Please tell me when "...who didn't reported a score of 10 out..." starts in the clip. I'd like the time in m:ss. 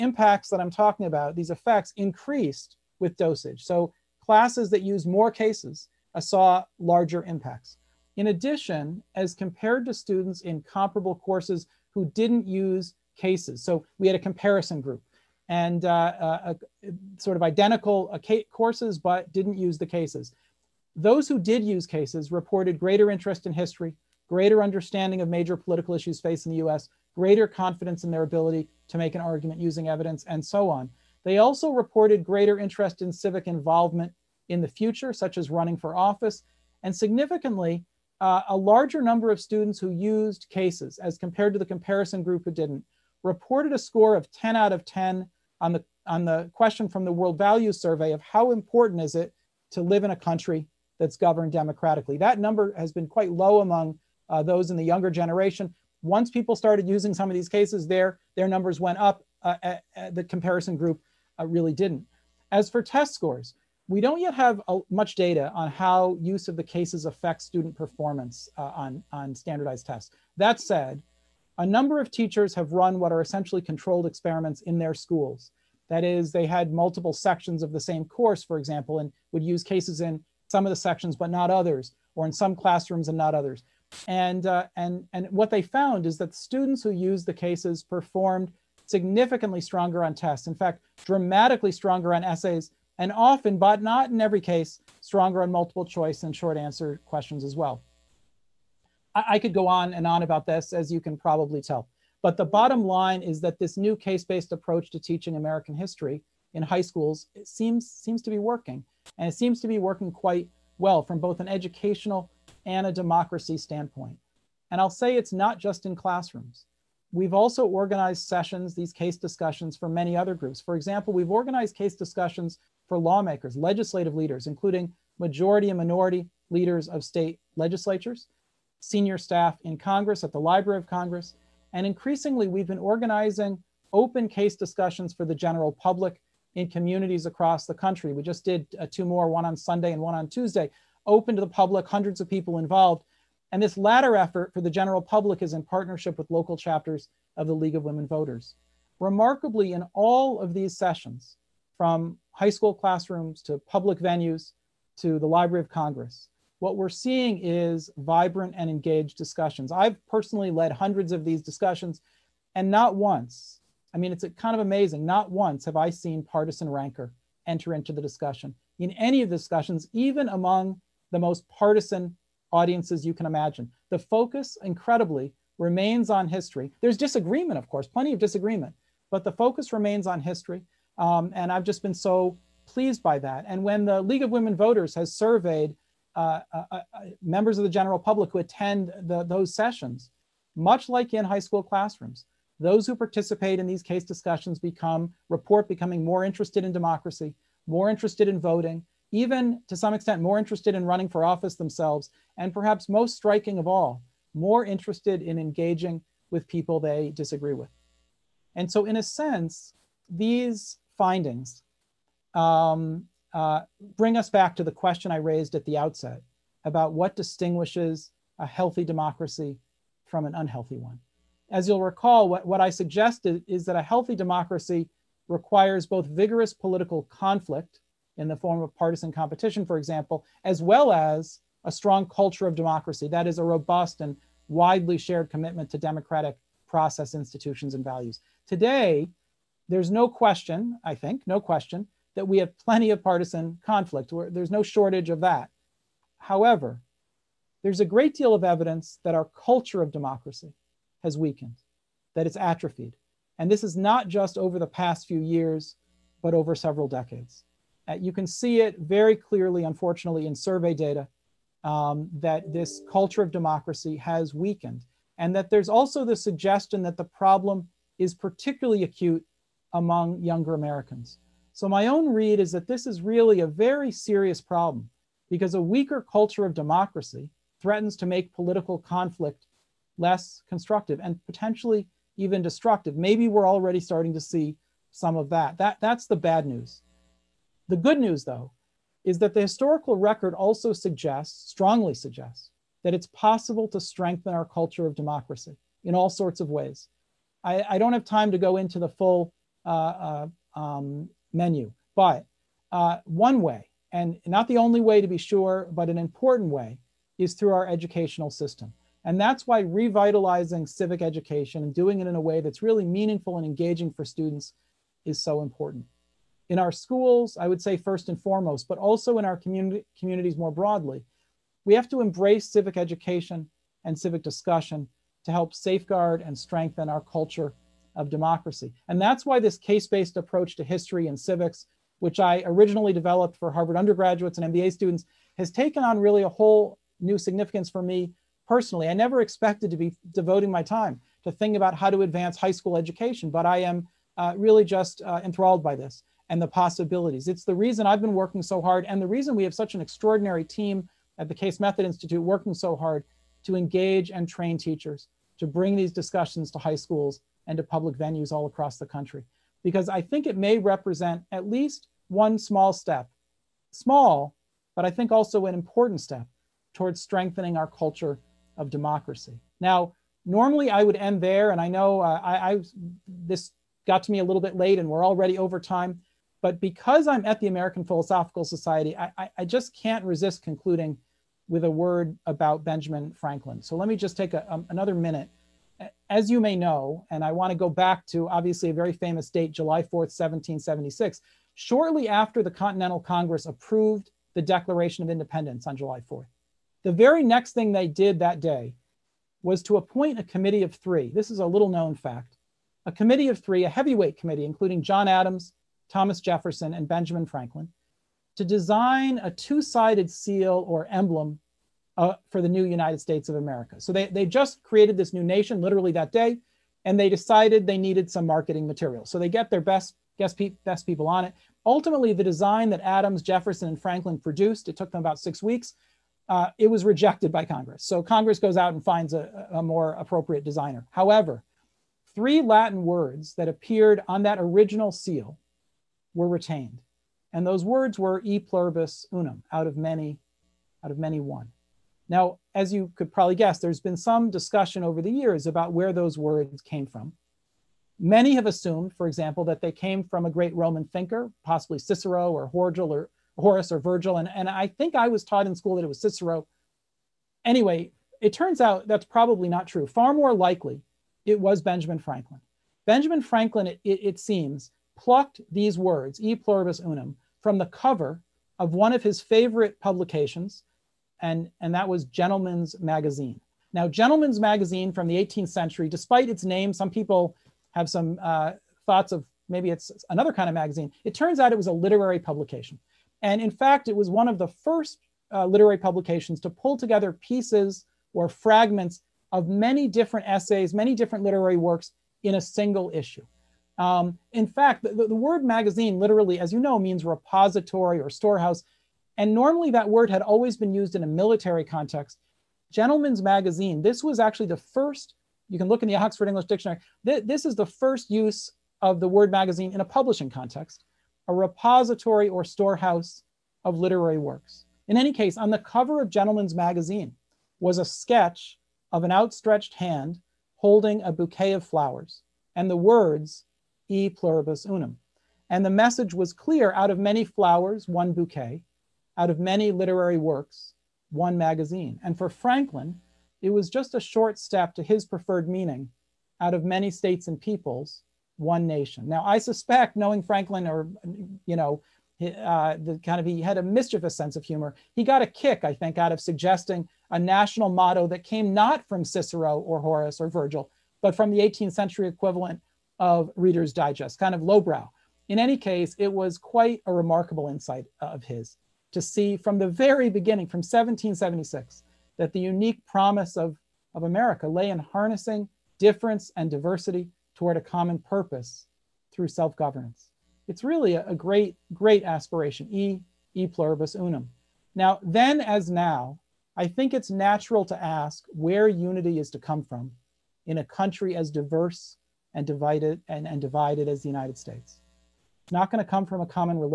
0:42.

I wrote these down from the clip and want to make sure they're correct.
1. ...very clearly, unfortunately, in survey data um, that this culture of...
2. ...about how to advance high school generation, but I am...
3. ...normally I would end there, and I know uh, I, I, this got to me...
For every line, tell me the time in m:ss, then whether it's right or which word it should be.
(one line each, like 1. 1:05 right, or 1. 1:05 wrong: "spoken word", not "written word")
1. 4:18 right
2. 5:41 wrong: "education", not "generation"
3. 6:10 right.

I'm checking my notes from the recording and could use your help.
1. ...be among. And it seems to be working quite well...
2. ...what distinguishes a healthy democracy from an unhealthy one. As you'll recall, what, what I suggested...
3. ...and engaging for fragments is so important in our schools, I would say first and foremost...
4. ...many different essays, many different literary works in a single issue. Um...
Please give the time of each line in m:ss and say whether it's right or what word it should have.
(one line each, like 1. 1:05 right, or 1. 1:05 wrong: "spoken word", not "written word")
1. 1:48 wrong: "working", not "among"
2. 3:36 right
3. 5:13 wrong: "students", not "fragments"
4. 8:09 right.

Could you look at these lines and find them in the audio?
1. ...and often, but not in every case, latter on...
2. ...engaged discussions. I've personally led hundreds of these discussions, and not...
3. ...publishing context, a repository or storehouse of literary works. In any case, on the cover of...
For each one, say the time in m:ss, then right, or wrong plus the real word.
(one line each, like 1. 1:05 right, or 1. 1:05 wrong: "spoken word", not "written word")
1. 1:32 wrong: "stronger", not "latter"
2. 2:38 right
3. 8:29 right.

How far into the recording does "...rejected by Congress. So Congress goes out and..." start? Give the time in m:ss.
7:06.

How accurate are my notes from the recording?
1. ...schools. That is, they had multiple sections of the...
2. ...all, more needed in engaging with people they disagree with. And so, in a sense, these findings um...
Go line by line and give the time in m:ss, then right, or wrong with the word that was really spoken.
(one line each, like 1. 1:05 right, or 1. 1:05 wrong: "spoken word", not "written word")
1. 1:14 right
2. 3:23 wrong: "interested", not "needed".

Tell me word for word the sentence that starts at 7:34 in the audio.
And, and I think I was taught in school that it was Cicero.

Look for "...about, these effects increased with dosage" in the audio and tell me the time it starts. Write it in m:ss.
0:01.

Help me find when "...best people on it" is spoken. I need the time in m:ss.
7:00.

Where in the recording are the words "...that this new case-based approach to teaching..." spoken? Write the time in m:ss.
1:43.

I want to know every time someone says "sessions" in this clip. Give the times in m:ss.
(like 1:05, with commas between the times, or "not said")
1:58, 2:30, 3:09.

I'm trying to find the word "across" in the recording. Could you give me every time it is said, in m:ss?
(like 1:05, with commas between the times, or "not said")
2:17, 5:58.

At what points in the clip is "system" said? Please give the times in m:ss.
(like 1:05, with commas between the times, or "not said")
5:08.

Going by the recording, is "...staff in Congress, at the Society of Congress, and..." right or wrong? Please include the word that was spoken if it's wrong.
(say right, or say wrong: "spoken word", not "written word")
wrong: "Library", not "Society".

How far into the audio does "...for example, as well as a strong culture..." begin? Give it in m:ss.
3:49.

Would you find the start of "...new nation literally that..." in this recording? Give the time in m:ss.
6:55.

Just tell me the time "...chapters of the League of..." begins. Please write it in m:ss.
2:26.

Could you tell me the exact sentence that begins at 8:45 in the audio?
And the message was clear out of many flowers, one bouquet, out of many literary works, one magazine.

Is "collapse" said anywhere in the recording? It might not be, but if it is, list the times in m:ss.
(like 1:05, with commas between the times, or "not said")
not said.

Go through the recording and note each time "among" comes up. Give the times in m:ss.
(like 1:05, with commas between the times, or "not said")
0:53, 2:50, 4:29.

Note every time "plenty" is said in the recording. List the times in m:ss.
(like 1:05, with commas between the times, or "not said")
2:57, 4:02.